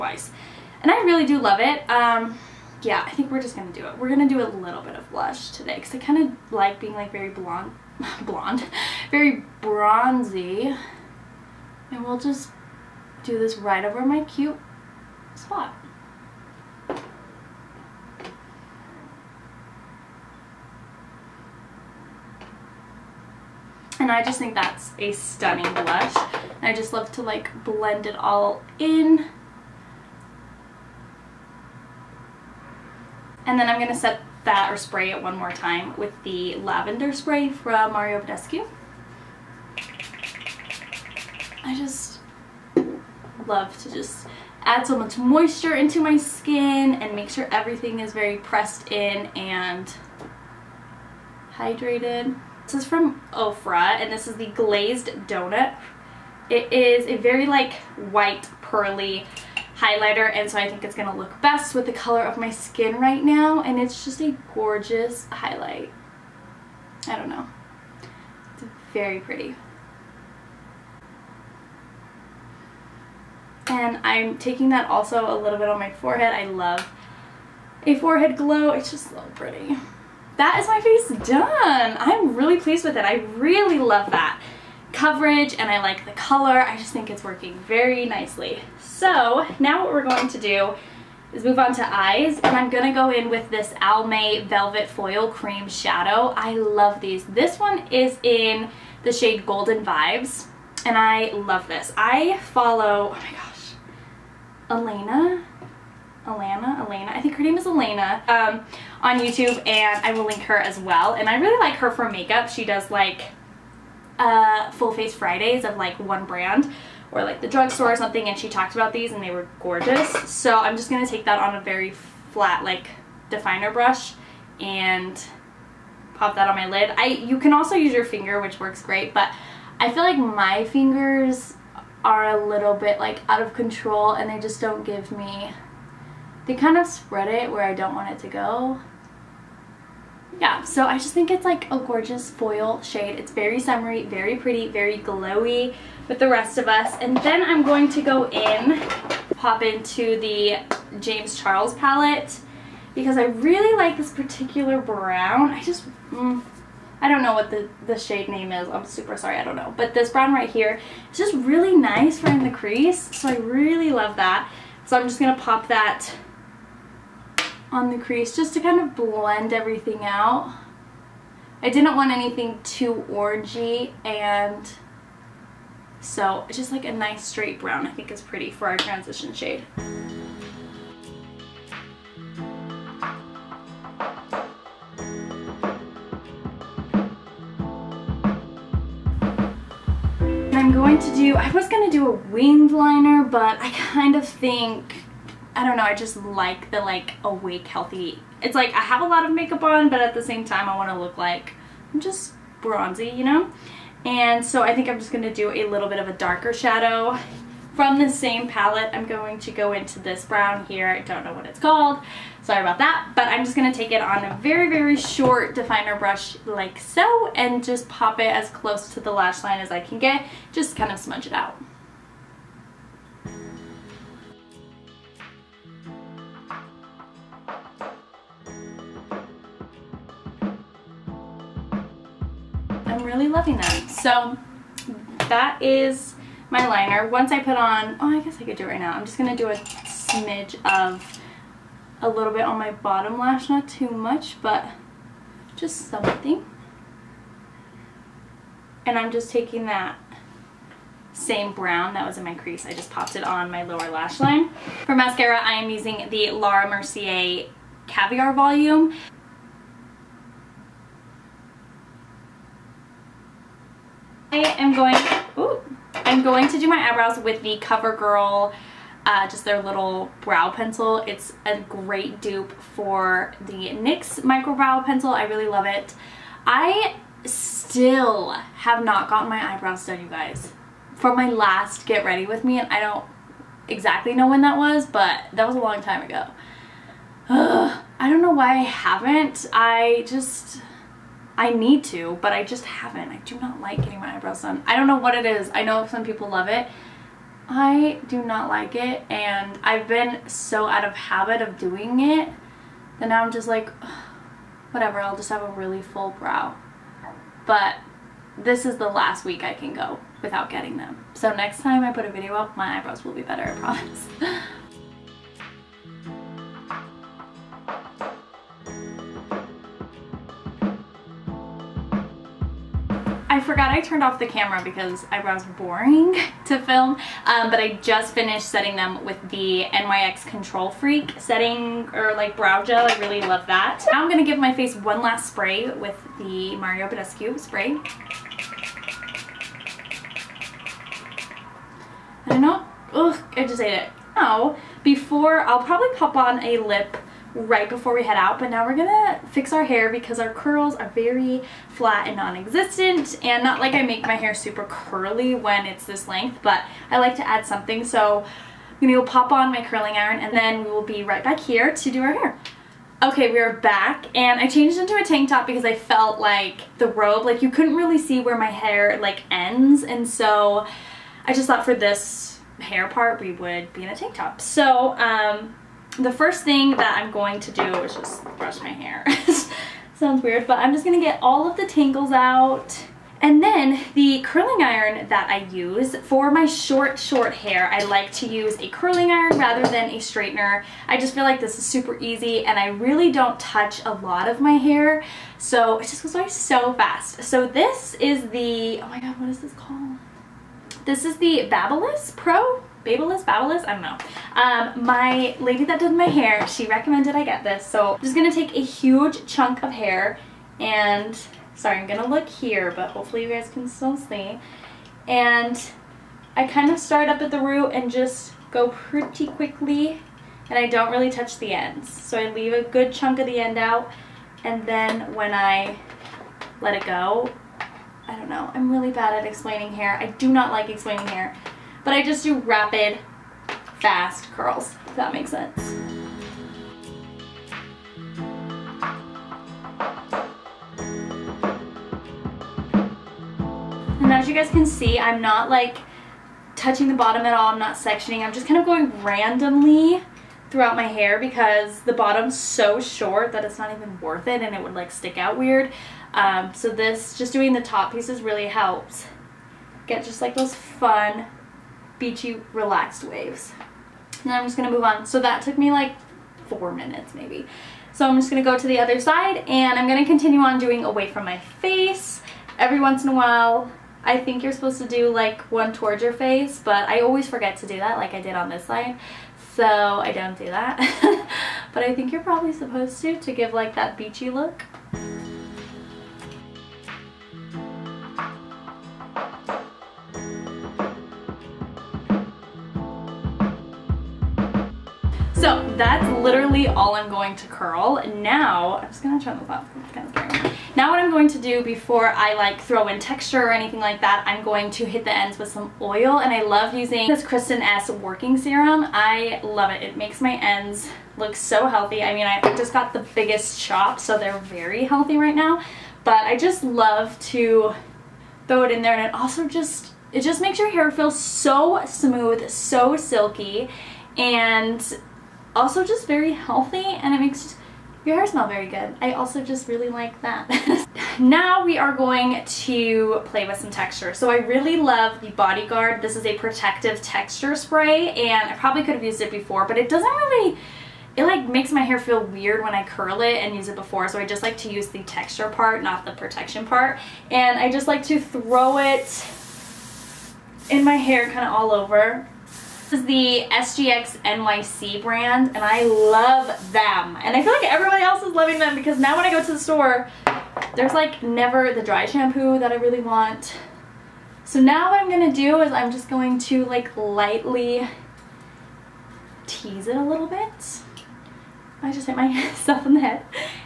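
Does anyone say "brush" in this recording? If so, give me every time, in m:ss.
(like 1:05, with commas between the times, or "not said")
2:03, 3:35, 6:18.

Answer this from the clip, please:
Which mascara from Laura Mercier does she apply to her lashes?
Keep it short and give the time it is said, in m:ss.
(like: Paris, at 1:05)
Caviar Volume, at 4:17.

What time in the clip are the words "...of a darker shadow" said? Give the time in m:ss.
3:25.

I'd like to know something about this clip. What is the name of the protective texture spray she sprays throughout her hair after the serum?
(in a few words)
Bodyguard.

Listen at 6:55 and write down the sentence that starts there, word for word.
And I kind of start up at the root and just go pretty quickly and I don't really touch the ends.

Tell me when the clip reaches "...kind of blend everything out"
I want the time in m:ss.
2:48.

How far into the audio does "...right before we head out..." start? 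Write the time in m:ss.
5:47.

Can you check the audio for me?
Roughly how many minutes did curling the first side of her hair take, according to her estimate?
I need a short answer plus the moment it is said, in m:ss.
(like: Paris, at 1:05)
4, at 7:46.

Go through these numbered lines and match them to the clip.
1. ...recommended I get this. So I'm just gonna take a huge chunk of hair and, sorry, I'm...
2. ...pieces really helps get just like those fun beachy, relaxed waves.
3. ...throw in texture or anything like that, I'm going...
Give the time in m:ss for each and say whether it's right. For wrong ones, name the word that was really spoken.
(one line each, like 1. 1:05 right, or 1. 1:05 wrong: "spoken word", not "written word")
1. 6:46 right
2. 7:37 right
3. 8:22 right.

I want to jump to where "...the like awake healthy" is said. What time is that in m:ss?
3:16.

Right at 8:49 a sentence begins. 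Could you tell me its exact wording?
I also just really like that.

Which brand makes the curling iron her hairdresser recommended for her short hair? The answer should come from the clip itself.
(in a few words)
Babyliss Pro.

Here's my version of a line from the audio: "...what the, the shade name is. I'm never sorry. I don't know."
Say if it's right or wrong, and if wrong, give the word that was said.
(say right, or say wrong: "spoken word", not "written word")
wrong: "super", not "never".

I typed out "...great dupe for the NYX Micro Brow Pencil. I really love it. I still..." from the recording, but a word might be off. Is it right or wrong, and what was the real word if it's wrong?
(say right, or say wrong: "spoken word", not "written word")
right.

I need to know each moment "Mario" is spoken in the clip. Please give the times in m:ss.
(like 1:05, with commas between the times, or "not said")
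0:37, 5:36.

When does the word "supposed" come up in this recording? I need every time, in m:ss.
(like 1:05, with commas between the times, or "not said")
7:54, 8:02.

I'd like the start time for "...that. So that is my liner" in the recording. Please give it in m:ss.
3:53.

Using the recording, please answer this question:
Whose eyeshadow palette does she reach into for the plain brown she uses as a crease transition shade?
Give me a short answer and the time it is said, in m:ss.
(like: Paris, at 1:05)
James Charles, at 2:30.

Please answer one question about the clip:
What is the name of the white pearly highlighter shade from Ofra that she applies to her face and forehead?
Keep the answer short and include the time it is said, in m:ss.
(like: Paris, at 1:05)
Glazed Donut, at 0:54.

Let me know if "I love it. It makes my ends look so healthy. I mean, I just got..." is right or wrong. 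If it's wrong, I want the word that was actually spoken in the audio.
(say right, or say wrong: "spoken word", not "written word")
right.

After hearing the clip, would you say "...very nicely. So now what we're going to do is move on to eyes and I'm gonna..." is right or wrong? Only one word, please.
right.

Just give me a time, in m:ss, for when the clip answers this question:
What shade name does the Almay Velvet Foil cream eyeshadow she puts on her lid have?
1:39.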